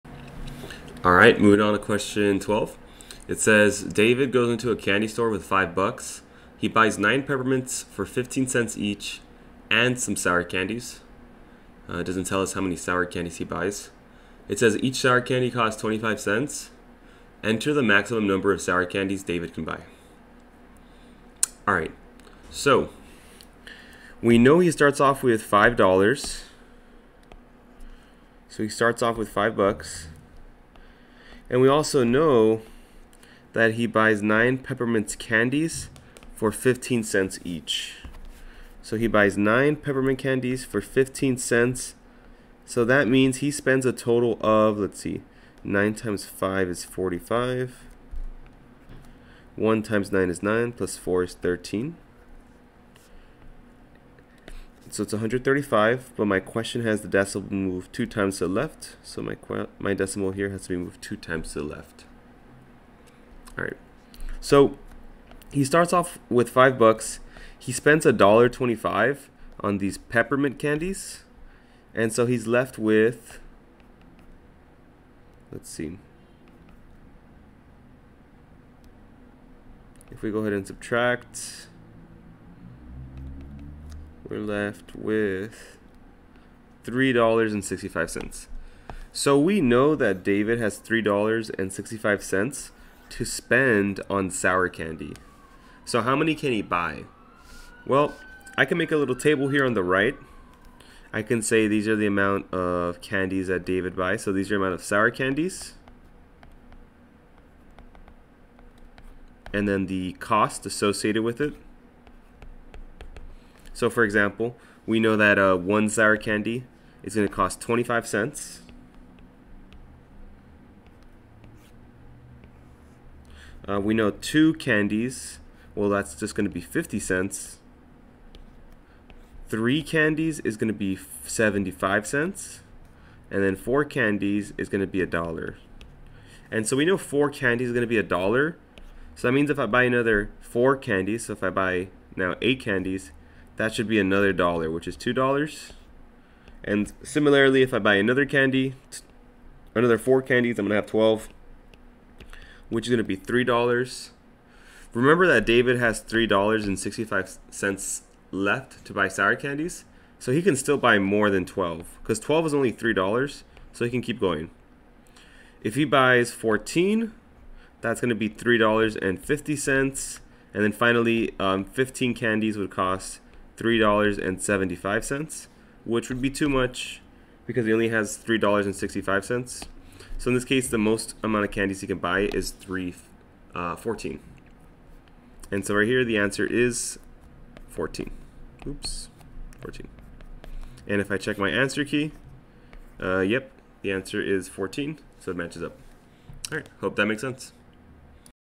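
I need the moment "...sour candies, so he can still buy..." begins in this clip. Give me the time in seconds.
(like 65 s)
159 s.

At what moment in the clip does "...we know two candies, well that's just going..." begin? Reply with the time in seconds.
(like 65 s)
123 s.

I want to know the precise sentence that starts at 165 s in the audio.
If he buys fourteen, that's gonna be three dollars and fifty cents.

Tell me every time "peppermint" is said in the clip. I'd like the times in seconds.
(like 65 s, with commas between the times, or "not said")
7 s, 34 s, 39 s, 69 s.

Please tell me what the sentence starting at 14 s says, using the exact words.
It says each sour candy costs 25 cents.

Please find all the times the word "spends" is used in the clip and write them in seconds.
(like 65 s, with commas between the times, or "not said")
43 s, 67 s, 93 s.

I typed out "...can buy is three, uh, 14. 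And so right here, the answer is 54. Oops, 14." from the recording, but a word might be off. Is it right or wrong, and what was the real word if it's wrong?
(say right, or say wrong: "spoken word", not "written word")
wrong: "14", not "54".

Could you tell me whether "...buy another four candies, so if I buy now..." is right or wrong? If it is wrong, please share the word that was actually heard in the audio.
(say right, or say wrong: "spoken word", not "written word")
right.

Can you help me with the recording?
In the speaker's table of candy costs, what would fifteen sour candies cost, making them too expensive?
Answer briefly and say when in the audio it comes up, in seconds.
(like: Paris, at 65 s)
$3.75, at 173 s.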